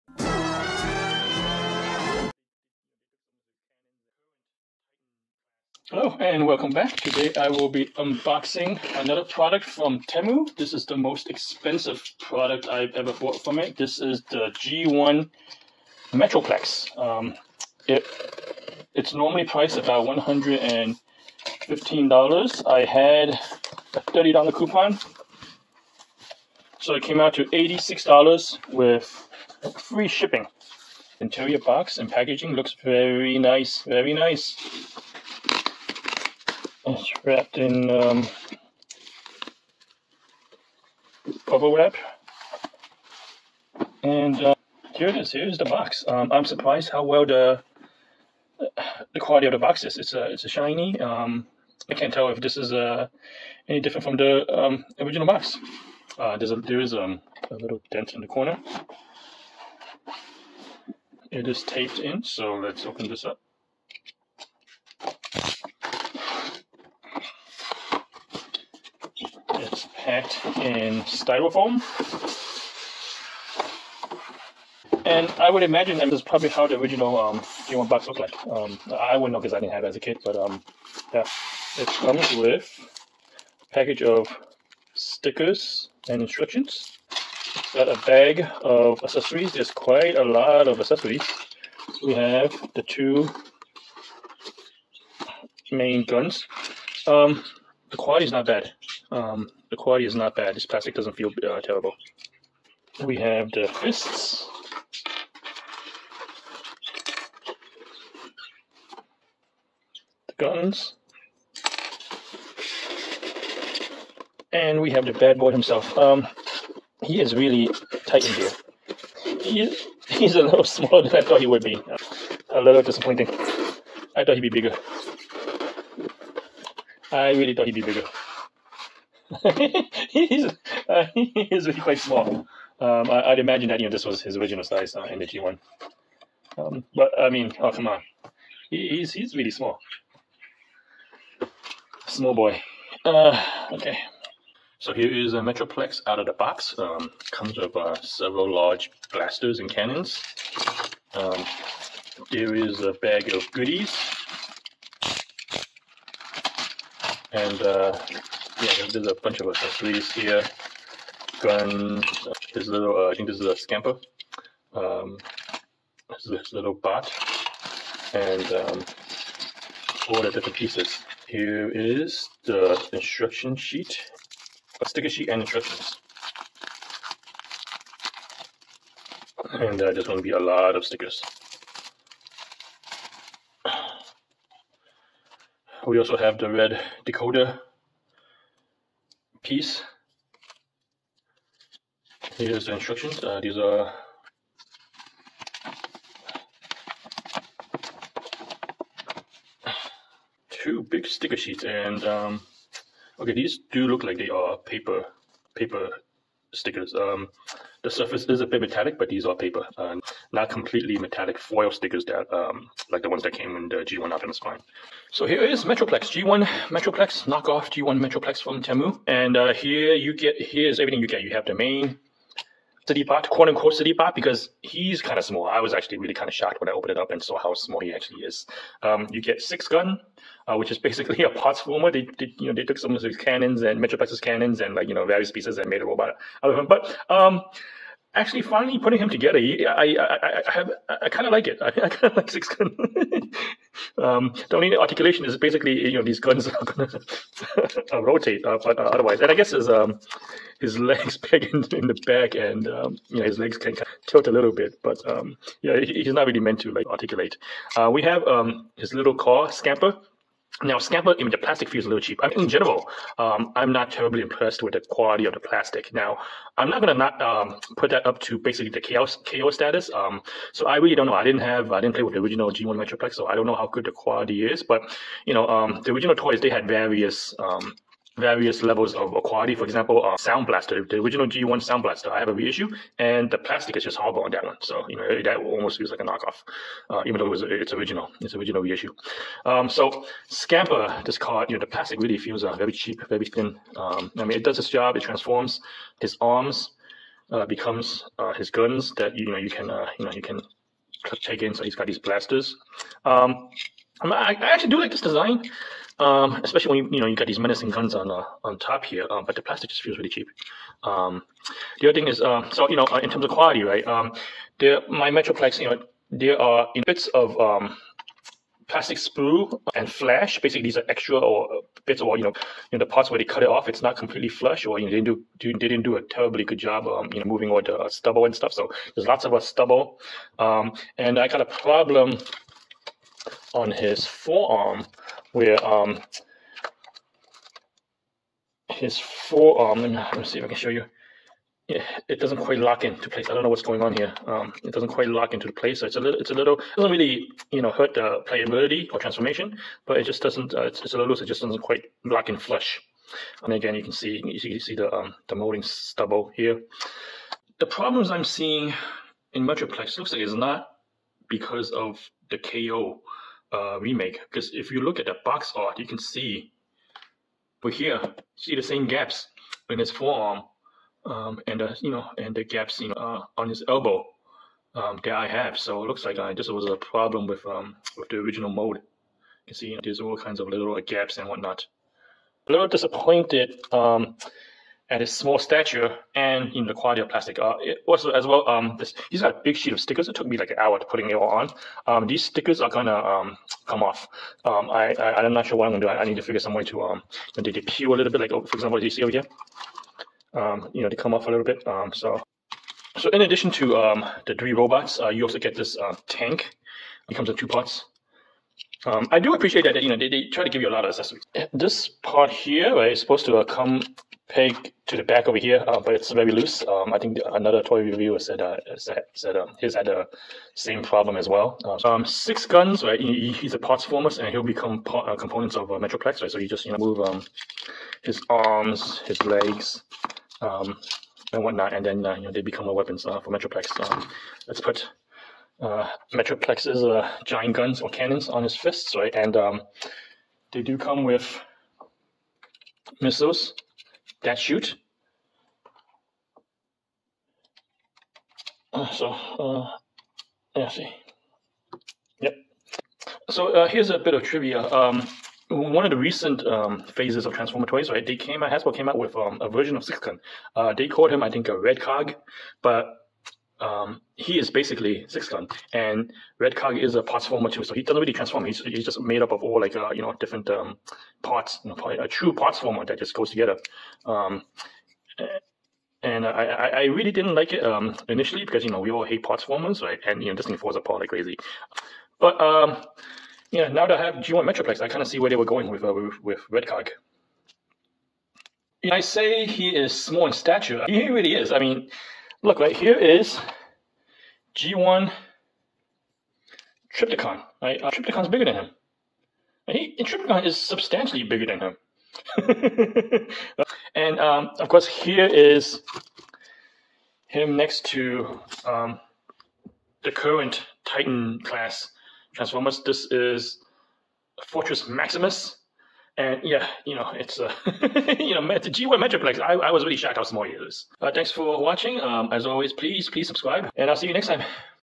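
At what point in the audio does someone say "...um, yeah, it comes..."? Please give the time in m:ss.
1:20.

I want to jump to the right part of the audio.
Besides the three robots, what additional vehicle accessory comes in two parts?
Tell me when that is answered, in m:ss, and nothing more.
6:46.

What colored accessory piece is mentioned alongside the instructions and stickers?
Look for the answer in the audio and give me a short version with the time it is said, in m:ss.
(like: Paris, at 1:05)
red decoder piece, at 3:06.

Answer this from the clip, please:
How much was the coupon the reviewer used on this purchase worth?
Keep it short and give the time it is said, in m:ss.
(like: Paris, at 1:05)
$30, at 0:23.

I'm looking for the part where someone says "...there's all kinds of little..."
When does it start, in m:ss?
6:19.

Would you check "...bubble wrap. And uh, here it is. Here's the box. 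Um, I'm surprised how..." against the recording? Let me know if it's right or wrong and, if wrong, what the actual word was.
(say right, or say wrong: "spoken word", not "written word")
right.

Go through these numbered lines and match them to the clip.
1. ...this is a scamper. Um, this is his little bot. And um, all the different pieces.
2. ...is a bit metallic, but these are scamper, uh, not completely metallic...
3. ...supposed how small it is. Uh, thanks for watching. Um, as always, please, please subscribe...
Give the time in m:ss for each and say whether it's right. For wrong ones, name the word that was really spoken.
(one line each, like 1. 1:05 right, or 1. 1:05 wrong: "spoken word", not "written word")
1. 2:43 right
2. 3:28 wrong: "paper", not "scamper"
3. 8:39 wrong: "shocked", not "supposed".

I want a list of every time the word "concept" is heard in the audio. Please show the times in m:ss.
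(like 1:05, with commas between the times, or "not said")
not said.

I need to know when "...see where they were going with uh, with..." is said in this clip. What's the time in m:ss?
8:05.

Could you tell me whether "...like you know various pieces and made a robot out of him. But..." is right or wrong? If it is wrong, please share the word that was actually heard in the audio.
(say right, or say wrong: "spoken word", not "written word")
right.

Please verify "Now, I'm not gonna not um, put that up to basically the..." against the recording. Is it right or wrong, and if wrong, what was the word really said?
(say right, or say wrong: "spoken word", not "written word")
right.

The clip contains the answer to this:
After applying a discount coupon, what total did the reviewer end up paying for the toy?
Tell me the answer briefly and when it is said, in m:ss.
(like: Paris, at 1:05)
$86, at 0:27.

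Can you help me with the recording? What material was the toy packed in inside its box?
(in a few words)
styrofoam.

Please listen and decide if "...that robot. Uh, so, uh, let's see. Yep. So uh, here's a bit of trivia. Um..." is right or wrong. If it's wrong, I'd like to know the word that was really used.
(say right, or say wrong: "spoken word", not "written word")
wrong: "shoot", not "robot".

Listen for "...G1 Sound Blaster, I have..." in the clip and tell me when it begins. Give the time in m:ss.
4:41.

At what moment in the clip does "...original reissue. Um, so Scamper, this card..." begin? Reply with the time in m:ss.
4:48.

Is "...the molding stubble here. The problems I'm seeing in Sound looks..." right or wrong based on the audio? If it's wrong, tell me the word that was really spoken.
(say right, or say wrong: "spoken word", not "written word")
wrong: "Metroplex", not "Sound".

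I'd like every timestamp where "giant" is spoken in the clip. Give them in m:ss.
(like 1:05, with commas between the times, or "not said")
7:17.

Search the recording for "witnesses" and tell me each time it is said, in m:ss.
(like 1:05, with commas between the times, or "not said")
not said.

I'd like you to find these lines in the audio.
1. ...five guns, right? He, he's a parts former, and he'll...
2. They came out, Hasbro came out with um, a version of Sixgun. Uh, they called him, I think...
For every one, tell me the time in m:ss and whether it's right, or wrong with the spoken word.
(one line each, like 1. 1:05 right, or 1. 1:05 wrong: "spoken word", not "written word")
1. 7:02 wrong: "six", not "five"
2. 7:38 right.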